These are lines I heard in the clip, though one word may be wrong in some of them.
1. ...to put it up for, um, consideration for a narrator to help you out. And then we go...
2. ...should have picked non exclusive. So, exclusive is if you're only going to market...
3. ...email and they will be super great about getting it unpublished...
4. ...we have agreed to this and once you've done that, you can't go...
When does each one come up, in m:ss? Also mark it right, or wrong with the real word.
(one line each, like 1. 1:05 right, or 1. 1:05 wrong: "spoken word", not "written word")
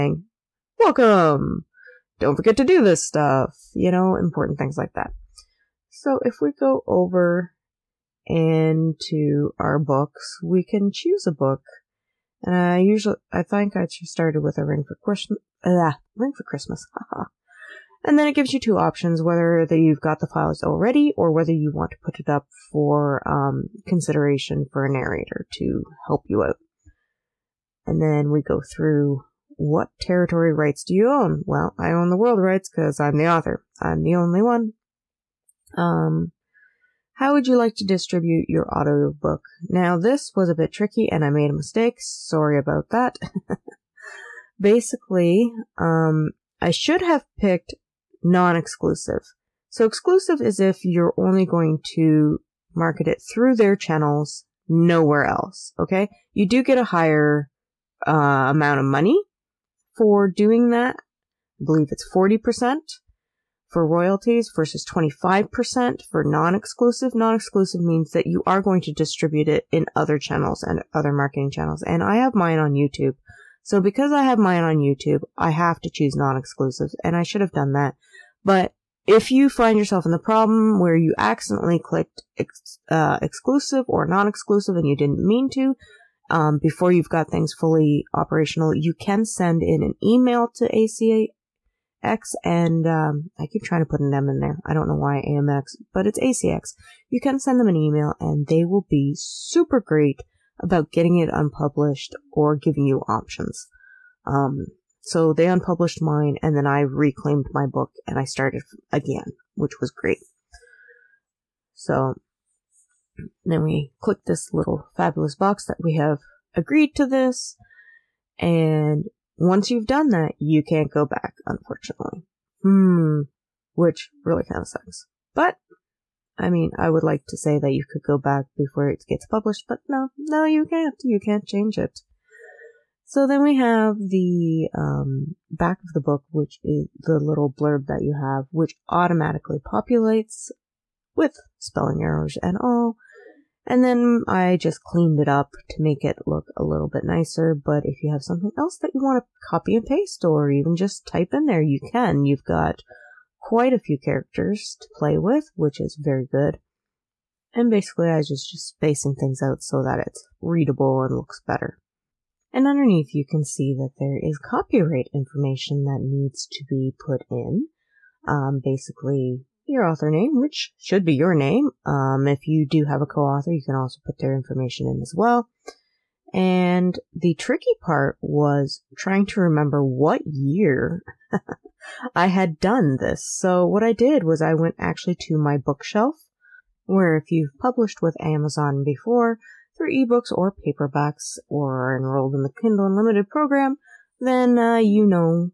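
1. 0:21 right
2. 0:46 right
3. 1:37 right
4. 1:55 right.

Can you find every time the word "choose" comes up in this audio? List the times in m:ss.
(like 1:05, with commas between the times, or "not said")
0:10, 1:15.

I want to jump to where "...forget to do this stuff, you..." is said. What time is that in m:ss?
0:02.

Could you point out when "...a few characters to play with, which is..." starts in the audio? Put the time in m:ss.
2:33.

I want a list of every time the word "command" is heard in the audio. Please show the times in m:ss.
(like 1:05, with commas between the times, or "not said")
not said.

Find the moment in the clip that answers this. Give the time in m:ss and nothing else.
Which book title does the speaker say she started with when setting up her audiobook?
0:14.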